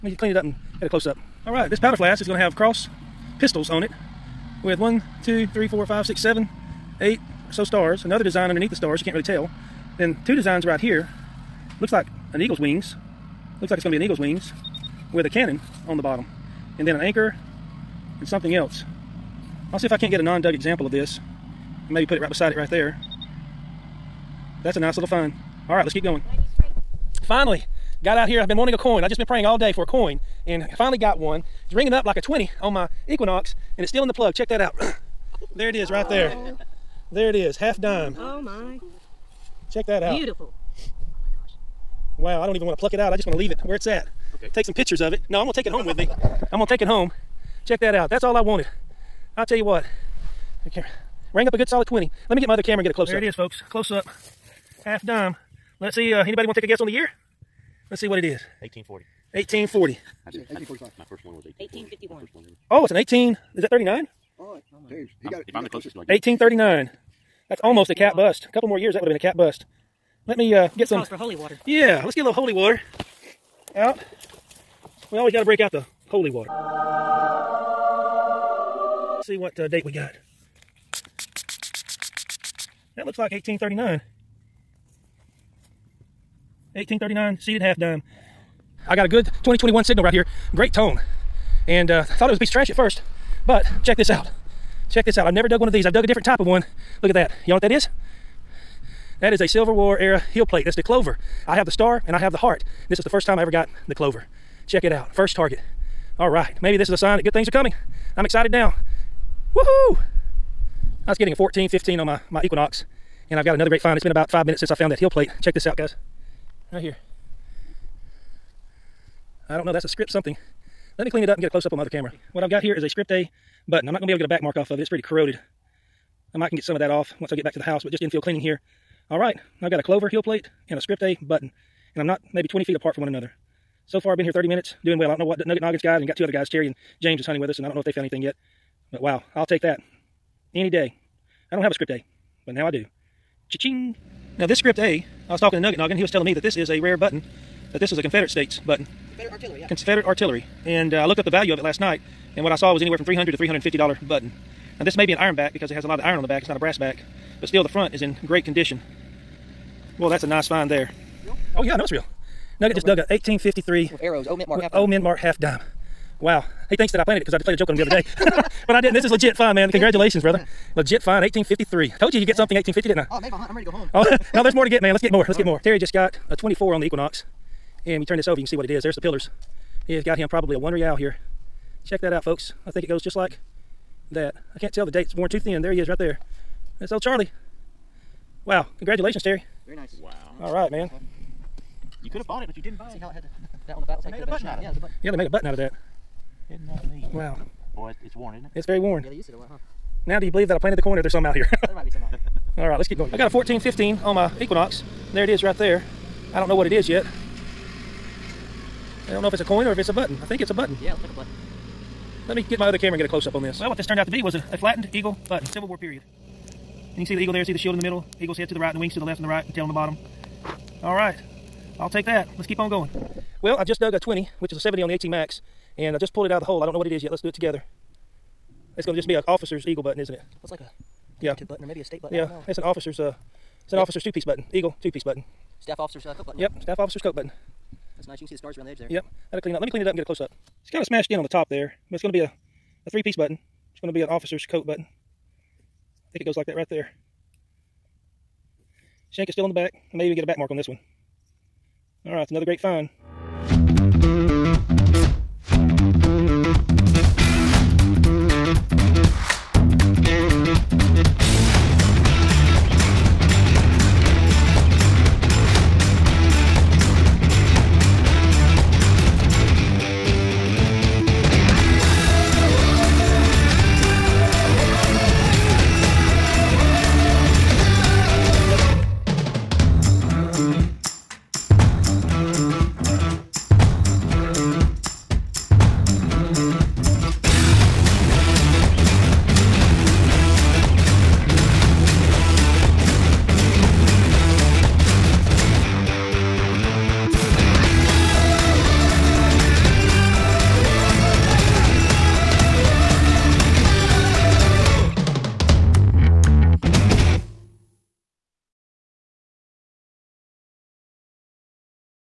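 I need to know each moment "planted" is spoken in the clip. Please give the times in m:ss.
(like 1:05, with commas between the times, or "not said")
2:47, 3:20.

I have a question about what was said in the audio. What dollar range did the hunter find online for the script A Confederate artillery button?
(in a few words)
$300 to $350.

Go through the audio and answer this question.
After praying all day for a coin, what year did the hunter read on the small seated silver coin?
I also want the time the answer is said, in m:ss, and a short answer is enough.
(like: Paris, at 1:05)
1839, at 1:26.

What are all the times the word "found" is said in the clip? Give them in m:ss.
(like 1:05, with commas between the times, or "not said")
1:54, 2:17.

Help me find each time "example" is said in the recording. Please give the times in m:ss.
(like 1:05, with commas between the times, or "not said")
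0:20.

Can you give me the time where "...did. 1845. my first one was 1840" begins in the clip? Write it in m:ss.
1:00.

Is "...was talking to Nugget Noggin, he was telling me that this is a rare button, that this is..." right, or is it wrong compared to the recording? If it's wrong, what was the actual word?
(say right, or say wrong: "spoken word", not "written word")
right.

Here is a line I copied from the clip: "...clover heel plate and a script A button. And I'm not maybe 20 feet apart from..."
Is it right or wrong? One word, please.
right.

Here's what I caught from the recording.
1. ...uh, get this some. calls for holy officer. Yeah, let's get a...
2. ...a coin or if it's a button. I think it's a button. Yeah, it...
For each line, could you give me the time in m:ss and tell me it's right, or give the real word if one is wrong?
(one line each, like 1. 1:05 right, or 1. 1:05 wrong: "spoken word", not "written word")
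1. 1:10 wrong: "water", not "officer"
2. 3:29 right.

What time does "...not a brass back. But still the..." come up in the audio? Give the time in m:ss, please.
2:36.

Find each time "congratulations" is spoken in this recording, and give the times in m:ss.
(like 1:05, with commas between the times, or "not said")
2:49, 3:08.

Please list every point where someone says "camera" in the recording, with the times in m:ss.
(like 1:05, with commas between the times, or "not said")
0:52, 2:01, 3:32.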